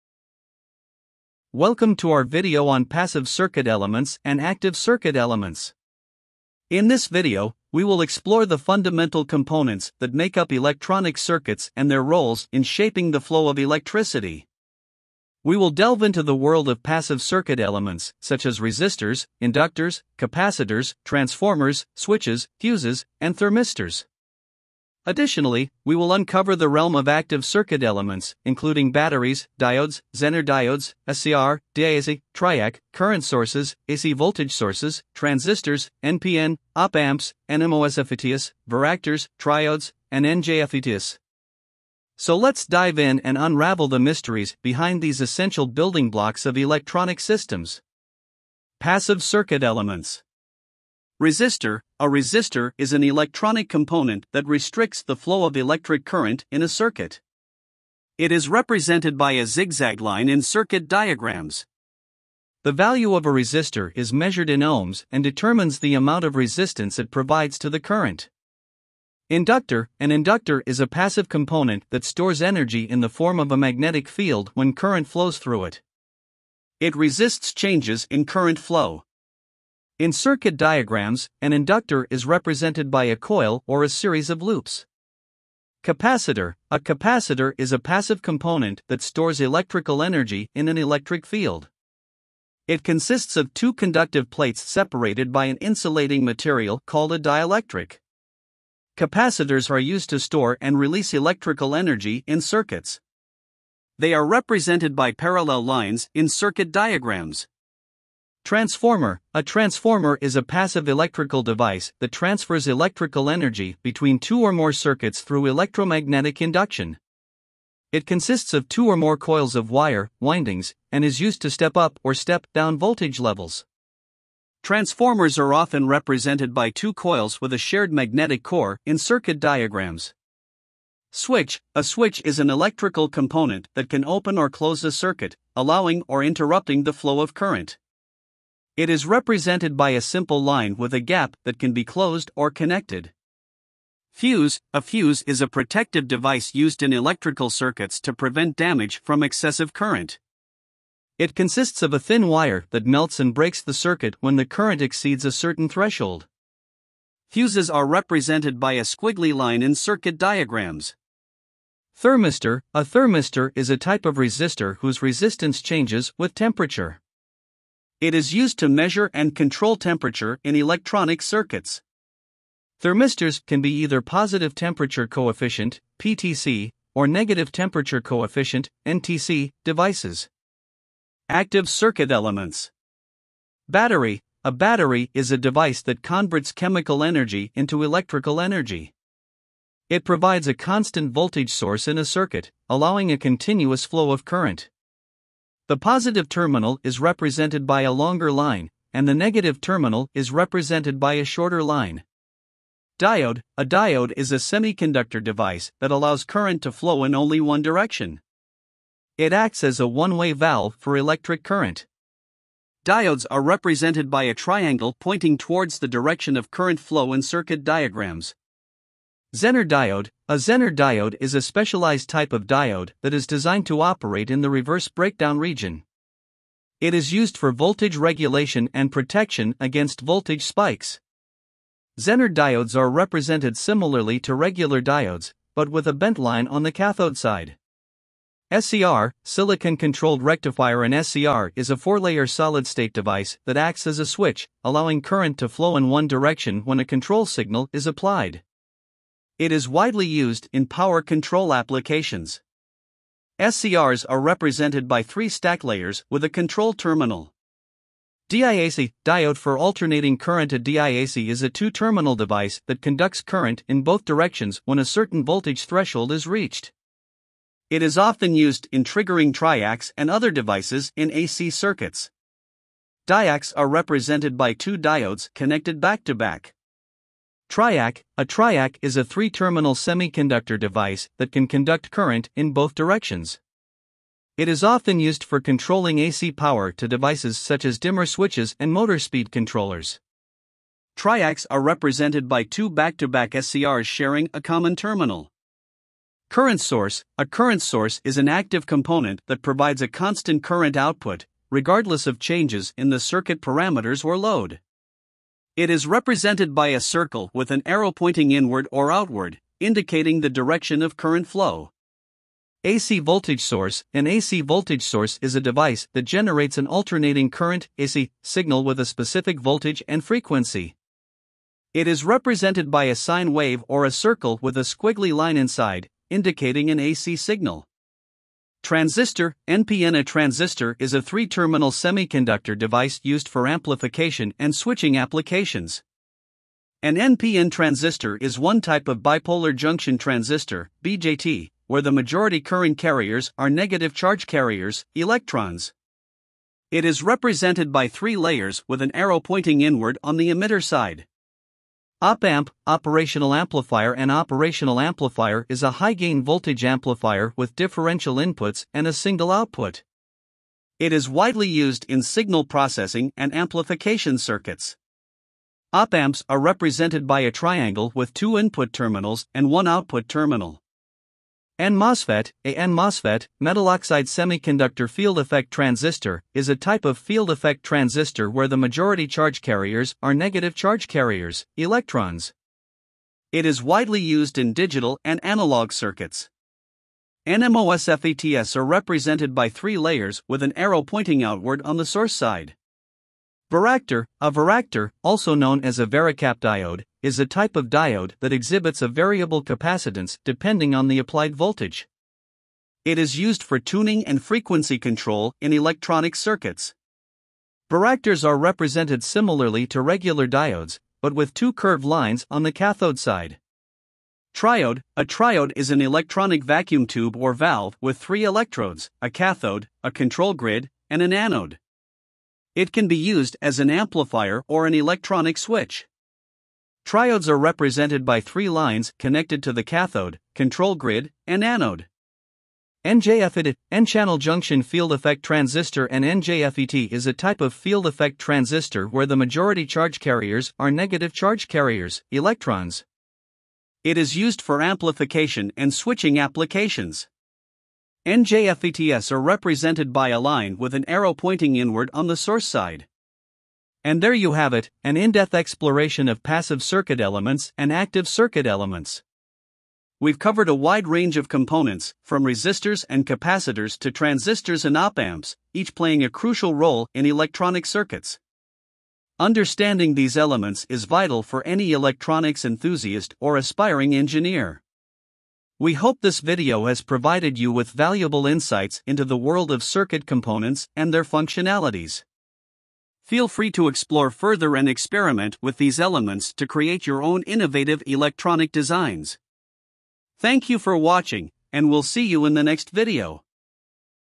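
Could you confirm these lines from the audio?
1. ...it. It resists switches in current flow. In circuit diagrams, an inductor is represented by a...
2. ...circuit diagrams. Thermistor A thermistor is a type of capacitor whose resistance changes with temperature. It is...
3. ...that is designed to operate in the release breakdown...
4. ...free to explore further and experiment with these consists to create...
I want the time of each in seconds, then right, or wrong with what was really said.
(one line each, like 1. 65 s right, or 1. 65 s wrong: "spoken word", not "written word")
1. 75 s wrong: "changes", not "switches"
2. 159 s wrong: "resistor", not "capacitor"
3. 223 s wrong: "reverse", not "release"
4. 483 s wrong: "elements", not "consists".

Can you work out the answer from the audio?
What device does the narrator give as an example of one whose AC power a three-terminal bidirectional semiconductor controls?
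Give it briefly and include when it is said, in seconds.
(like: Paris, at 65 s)
Dimmer switches, at 287 s.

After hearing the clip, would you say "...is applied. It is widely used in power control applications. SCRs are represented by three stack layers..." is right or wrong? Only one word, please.
right.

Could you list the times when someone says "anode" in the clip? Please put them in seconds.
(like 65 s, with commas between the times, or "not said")
421 s, 431 s.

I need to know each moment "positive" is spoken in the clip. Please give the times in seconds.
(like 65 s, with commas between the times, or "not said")
174 s, 195 s.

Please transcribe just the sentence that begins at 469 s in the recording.
Understanding these elements is vital for any electronics enthusiast or aspiring engineer.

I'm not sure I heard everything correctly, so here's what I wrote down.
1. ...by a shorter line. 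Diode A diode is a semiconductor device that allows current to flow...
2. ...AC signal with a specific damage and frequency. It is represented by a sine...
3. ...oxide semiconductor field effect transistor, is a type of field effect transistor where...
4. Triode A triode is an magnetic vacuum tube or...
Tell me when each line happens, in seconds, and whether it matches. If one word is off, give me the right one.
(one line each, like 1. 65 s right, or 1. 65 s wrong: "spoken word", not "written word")
1. 200 s right
2. 317 s wrong: "voltage", not "damage"
3. 373 s right
4. 414 s wrong: "electronic", not "magnetic".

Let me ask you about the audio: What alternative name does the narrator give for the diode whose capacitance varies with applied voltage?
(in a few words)
Varicap diode.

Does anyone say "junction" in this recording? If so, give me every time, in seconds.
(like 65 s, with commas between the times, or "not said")
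339 s, 434 s.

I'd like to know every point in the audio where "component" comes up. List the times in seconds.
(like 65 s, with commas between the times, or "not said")
9 s, 53 s, 71 s, 88 s, 133 s, 298 s, 461 s, 480 s.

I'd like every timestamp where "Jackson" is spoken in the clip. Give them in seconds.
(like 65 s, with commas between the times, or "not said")
not said.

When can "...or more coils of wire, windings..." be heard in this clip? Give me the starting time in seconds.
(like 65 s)
118 s.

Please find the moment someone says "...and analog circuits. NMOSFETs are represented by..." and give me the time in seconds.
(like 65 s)
385 s.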